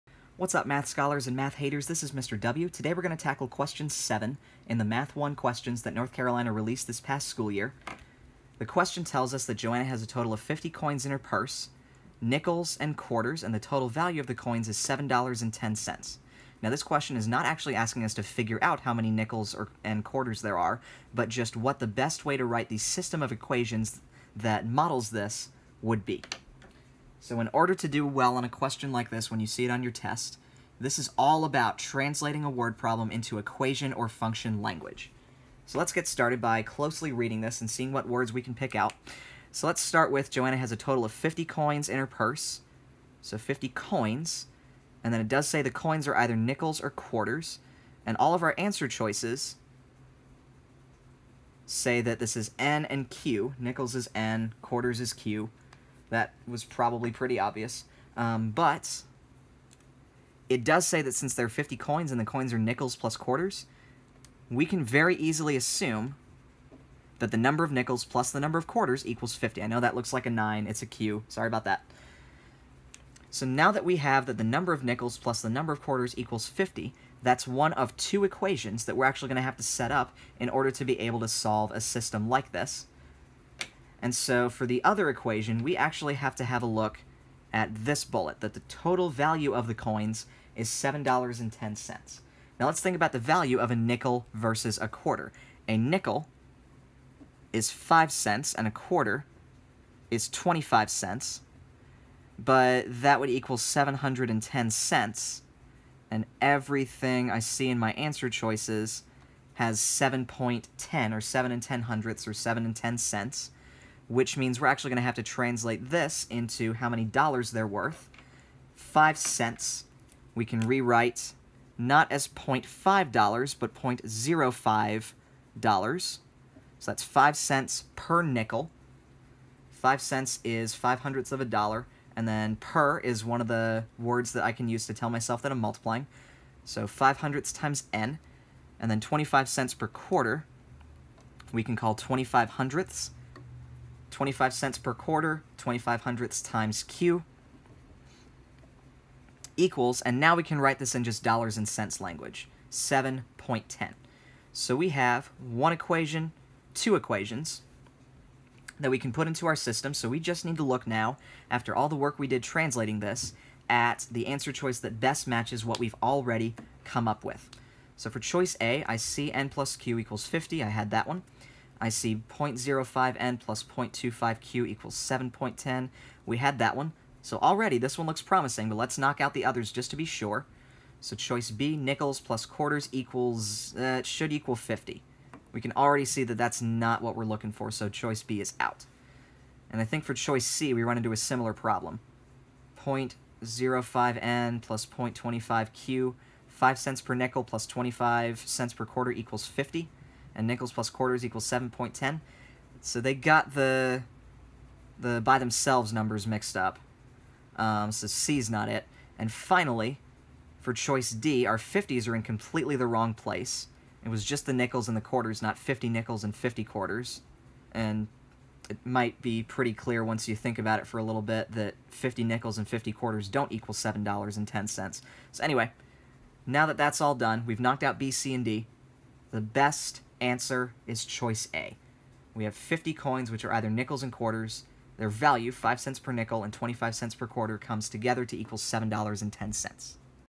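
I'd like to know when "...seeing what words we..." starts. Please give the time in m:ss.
0:37.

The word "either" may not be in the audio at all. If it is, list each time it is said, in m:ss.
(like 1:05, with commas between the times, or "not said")
0:46, 3:53.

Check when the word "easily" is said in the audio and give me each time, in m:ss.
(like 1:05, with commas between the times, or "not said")
1:05.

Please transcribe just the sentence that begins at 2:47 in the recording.
So for choice A, I see n plus q equals 50.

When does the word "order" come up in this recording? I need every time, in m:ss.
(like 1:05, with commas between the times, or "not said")
0:27, 1:20.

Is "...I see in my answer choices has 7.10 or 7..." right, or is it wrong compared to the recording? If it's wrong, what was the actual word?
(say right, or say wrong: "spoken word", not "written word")
right.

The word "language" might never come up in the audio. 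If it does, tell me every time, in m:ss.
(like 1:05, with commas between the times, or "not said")
0:34, 2:31.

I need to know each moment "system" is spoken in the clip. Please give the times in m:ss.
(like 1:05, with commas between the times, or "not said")
0:22, 1:21, 2:39.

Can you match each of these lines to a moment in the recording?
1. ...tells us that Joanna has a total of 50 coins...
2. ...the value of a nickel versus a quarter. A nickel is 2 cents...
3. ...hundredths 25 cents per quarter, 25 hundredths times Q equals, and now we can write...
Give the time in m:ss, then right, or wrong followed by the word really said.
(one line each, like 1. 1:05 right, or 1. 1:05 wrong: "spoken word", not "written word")
1. 0:09 right
2. 1:33 wrong: "5", not "2"
3. 2:22 right.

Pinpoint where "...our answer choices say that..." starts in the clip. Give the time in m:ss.
0:48.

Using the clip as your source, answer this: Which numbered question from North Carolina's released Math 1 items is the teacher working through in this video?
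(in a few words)
7.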